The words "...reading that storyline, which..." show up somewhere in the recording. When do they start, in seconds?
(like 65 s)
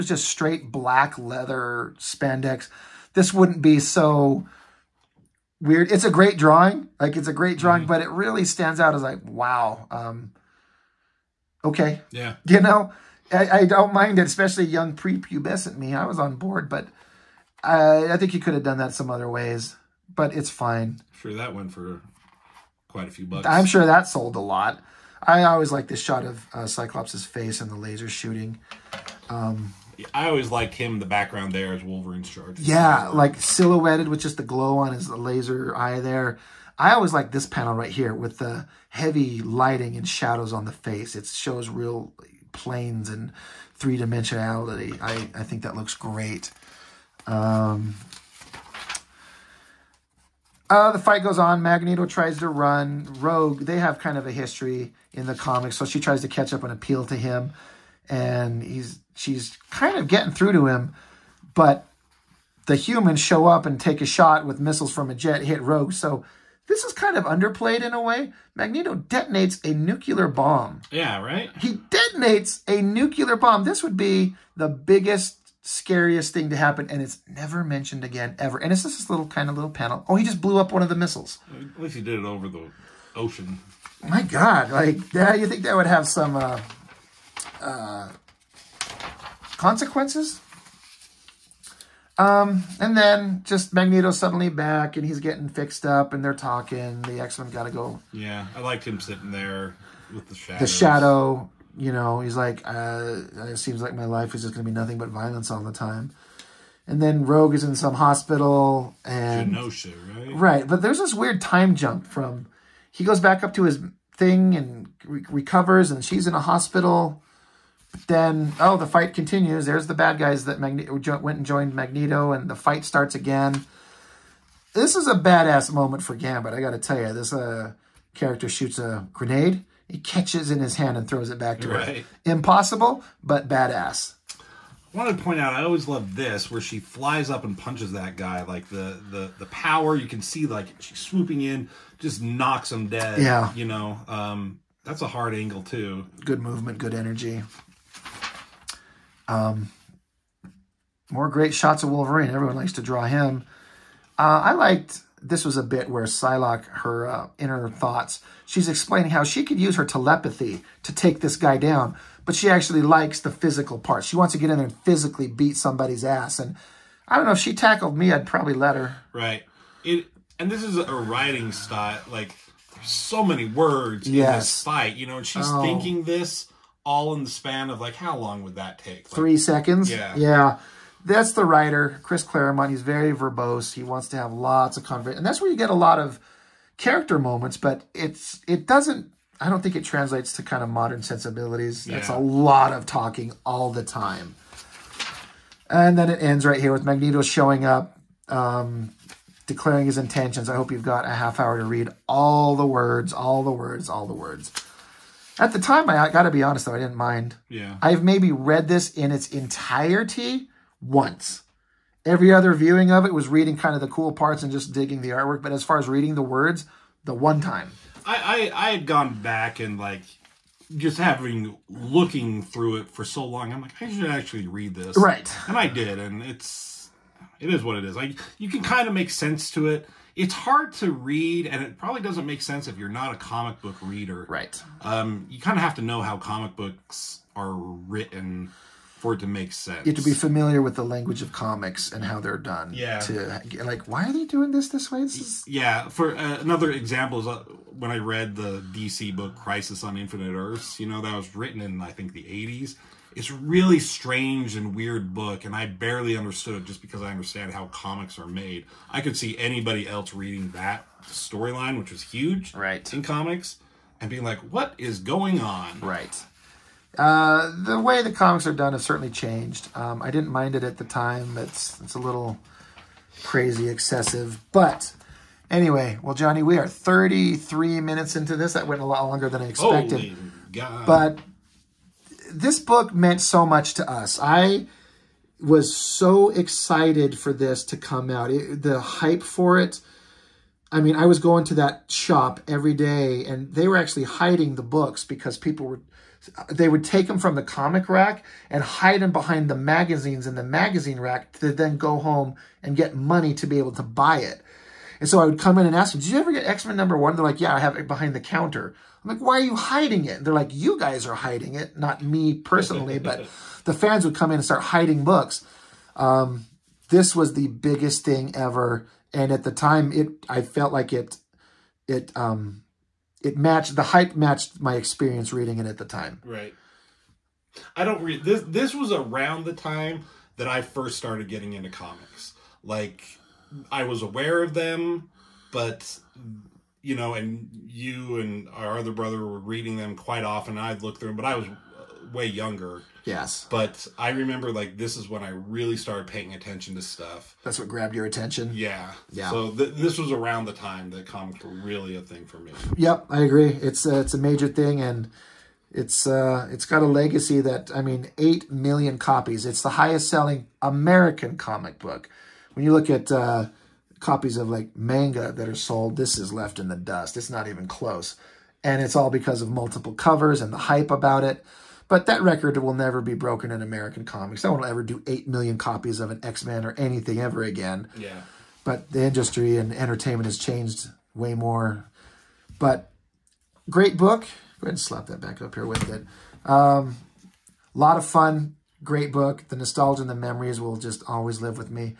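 260 s.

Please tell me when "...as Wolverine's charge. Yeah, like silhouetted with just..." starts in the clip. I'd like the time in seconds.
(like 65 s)
31 s.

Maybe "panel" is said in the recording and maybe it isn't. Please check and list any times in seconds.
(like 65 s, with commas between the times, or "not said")
37 s, 79 s.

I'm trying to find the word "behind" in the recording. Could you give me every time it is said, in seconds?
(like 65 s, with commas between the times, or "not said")
299 s, 307 s.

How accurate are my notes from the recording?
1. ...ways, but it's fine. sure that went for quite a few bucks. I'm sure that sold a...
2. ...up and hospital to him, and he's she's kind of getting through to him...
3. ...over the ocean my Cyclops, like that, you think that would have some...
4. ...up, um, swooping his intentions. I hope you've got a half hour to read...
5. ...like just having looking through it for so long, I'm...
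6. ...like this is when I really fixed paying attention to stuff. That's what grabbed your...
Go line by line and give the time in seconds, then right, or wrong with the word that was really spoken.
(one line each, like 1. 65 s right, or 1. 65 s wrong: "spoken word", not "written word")
1. 19 s right
2. 56 s wrong: "appeal", not "hospital"
3. 82 s wrong: "God", not "Cyclops"
4. 197 s wrong: "declaring", not "swooping"
5. 219 s right
6. 344 s wrong: "started", not "fixed".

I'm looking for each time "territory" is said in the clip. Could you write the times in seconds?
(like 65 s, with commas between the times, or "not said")
not said.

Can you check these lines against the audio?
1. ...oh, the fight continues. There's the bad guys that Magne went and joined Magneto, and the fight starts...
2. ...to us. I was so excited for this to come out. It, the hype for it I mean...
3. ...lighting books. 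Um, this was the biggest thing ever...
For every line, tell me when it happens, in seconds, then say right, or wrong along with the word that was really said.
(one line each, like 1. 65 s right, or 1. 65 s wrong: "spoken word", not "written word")
1. 118 s right
2. 283 s right
3. 314 s wrong: "hiding", not "lighting".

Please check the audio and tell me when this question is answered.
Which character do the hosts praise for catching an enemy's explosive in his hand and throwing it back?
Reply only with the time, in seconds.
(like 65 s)
126 s.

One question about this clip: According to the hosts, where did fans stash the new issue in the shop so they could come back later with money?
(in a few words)
magazine rack.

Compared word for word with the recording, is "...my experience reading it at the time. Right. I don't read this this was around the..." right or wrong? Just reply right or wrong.
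right.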